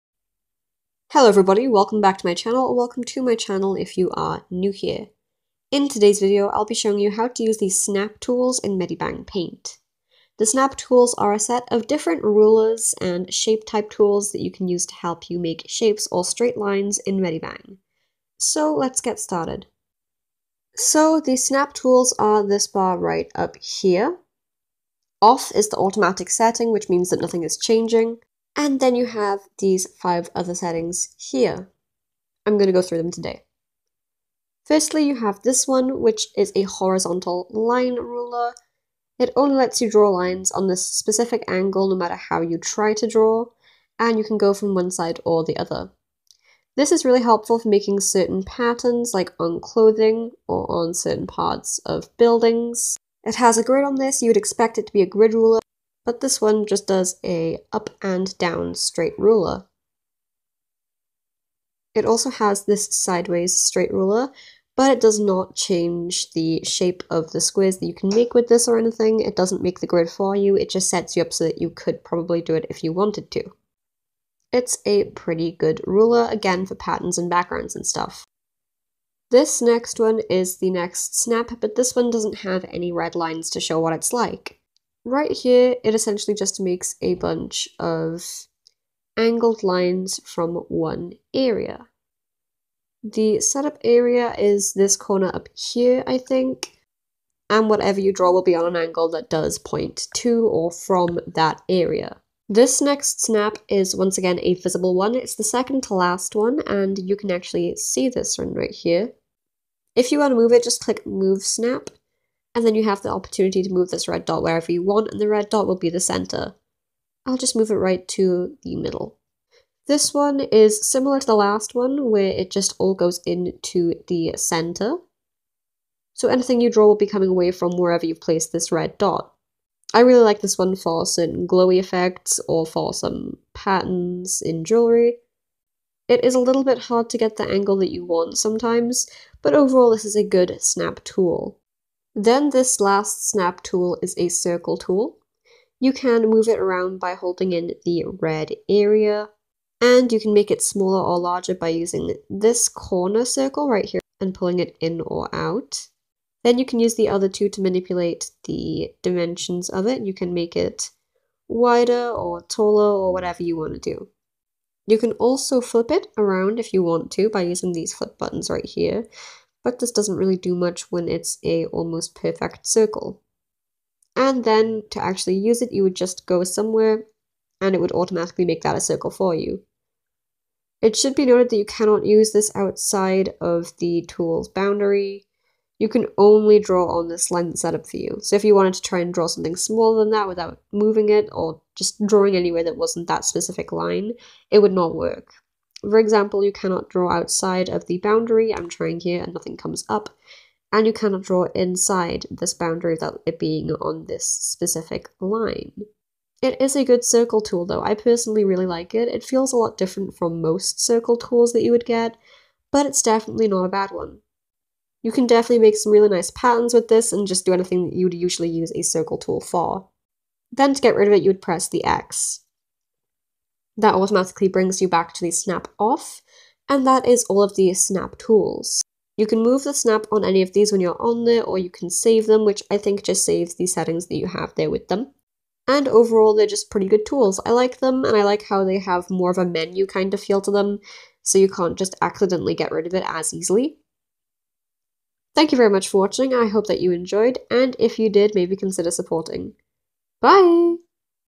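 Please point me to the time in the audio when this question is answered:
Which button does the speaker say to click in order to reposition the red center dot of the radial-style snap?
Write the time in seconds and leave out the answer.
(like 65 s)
111 s.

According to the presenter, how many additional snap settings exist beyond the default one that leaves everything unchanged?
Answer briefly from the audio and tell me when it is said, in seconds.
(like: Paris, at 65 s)
5, at 29 s.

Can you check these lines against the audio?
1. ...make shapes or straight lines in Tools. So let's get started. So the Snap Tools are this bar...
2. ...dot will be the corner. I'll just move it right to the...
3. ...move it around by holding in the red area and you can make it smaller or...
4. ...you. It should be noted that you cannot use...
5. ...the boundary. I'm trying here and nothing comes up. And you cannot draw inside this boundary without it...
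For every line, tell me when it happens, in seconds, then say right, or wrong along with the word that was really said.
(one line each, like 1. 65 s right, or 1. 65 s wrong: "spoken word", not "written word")
1. 15 s wrong: "Medibang", not "Tools"
2. 115 s wrong: "center", not "corner"
3. 146 s right
4. 179 s right
5. 197 s right.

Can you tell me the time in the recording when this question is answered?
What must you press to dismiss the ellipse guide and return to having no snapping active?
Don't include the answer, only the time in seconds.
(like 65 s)
221 s.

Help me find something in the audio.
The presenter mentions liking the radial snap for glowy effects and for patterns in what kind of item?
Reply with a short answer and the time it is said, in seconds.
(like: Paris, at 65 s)
Jewellery, at 134 s.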